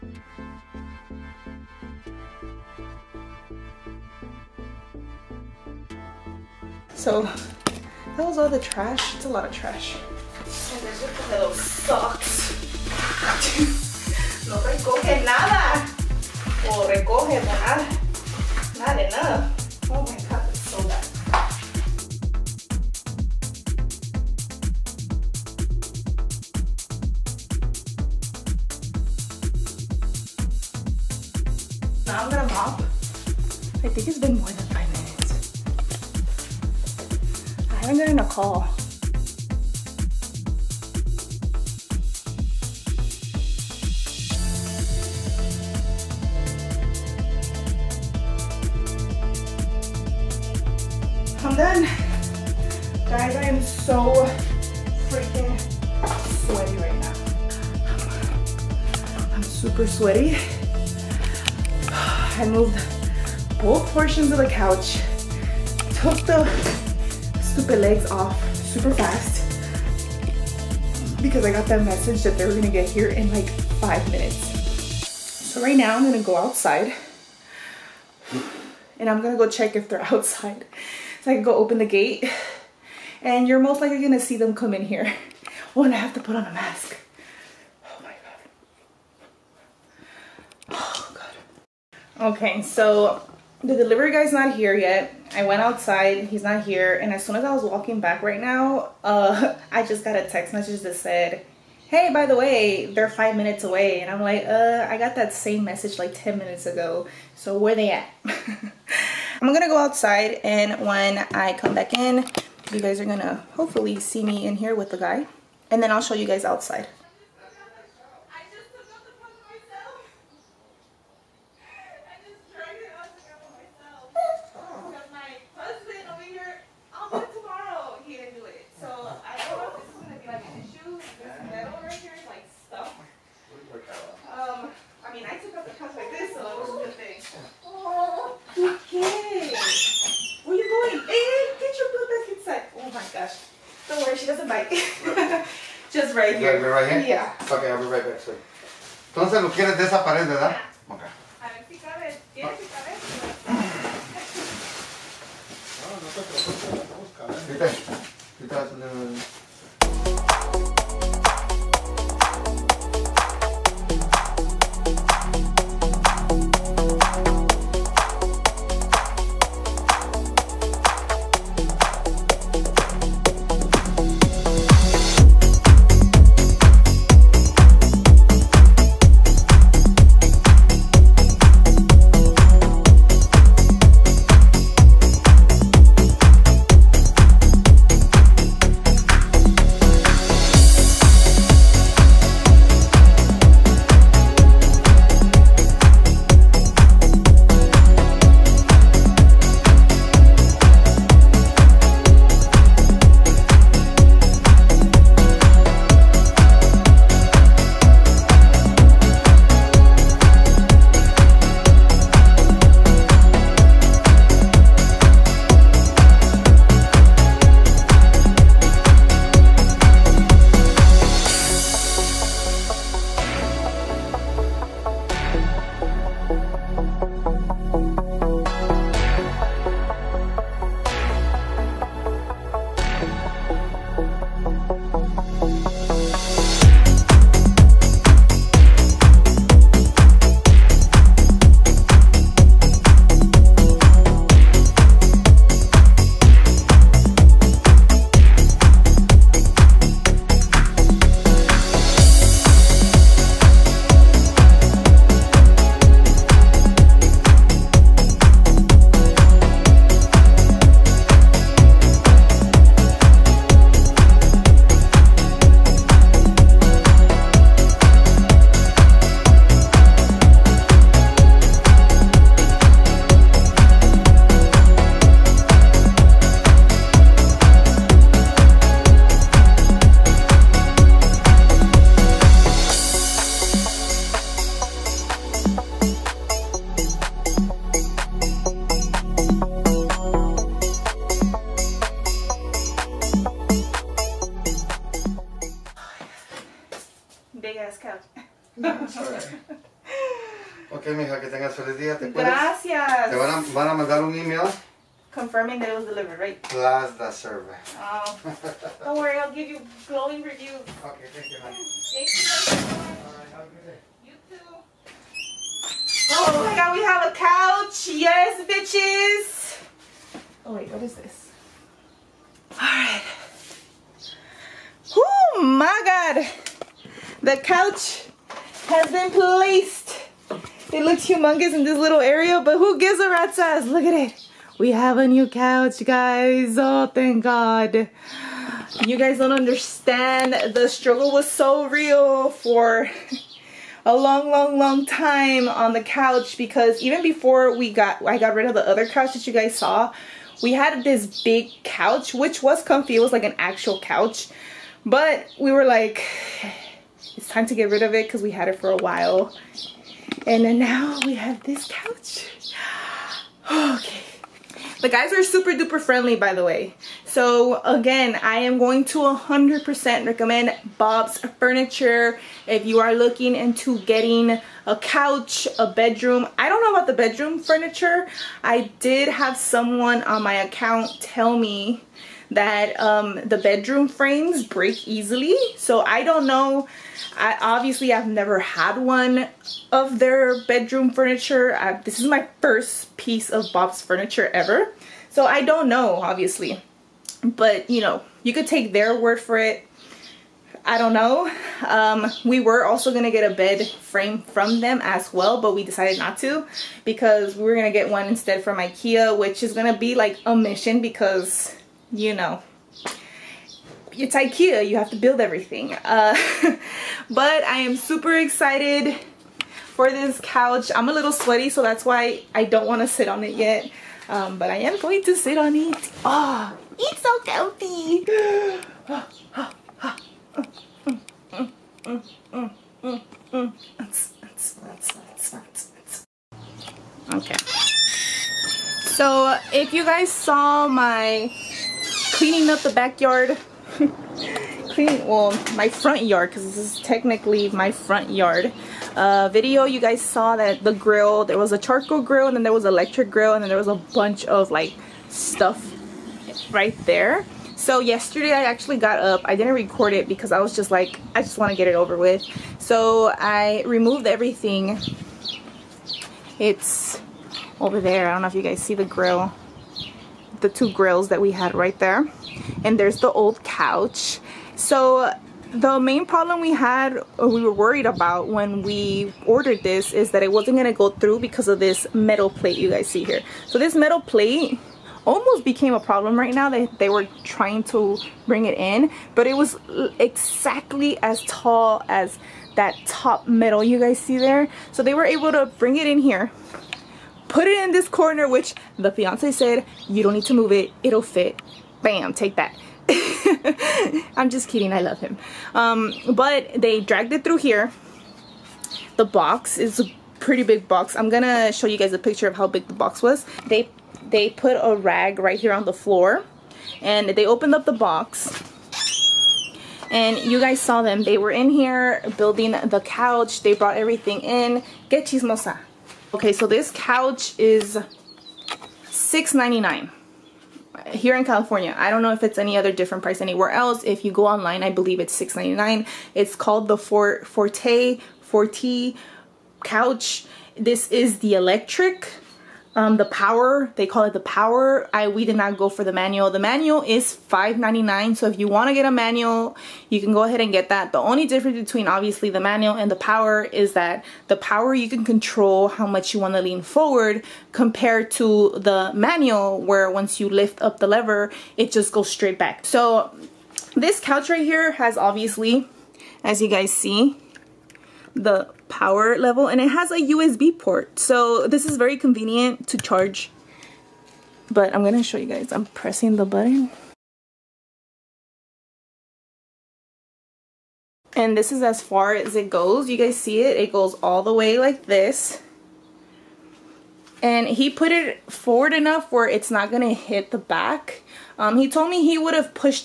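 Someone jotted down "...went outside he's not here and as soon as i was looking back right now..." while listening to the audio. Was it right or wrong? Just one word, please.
wrong.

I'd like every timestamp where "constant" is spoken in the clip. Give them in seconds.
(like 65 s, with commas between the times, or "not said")
not said.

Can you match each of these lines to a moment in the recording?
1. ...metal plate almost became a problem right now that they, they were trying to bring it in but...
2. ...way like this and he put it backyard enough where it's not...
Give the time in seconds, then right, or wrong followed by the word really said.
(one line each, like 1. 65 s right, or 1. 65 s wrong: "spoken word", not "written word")
1. 483 s right
2. 584 s wrong: "forward", not "backyard".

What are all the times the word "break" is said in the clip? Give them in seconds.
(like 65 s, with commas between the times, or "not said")
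384 s.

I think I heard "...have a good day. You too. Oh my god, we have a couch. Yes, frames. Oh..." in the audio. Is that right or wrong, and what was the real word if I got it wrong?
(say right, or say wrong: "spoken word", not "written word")
wrong: "bitches", not "frames".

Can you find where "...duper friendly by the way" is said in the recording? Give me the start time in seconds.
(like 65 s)
365 s.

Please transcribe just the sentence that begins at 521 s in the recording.
They were in here building the couch.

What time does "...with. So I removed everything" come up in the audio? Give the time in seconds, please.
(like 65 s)
461 s.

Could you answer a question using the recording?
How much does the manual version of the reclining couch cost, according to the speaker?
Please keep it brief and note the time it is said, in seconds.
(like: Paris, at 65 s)
5.99, at 547 s.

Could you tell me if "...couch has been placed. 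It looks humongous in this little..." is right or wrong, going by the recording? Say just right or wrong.
right.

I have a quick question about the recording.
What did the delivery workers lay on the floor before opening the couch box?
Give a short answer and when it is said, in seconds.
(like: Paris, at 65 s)
a rag, at 514 s.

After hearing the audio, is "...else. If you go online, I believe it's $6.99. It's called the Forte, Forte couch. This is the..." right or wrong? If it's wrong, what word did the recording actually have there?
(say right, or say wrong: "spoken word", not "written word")
right.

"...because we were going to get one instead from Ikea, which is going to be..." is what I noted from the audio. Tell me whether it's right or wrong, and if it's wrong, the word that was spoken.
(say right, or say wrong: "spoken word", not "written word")
right.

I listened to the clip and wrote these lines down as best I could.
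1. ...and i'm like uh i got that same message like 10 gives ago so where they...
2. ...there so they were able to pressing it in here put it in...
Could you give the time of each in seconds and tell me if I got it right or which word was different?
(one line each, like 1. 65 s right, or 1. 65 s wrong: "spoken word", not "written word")
1. 104 s wrong: "minutes", not "gives"
2. 494 s wrong: "bring", not "pressing".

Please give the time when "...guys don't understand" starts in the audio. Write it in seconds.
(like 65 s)
338 s.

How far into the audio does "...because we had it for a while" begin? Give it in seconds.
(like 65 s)
358 s.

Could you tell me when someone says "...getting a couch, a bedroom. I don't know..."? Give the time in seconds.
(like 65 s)
373 s.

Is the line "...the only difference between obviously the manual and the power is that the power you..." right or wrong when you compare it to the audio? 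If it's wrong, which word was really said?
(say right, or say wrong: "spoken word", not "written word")
right.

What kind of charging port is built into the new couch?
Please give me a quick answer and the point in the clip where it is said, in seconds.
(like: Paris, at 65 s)
USB port, at 570 s.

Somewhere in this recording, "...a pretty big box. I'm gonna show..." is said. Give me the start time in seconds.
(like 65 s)
509 s.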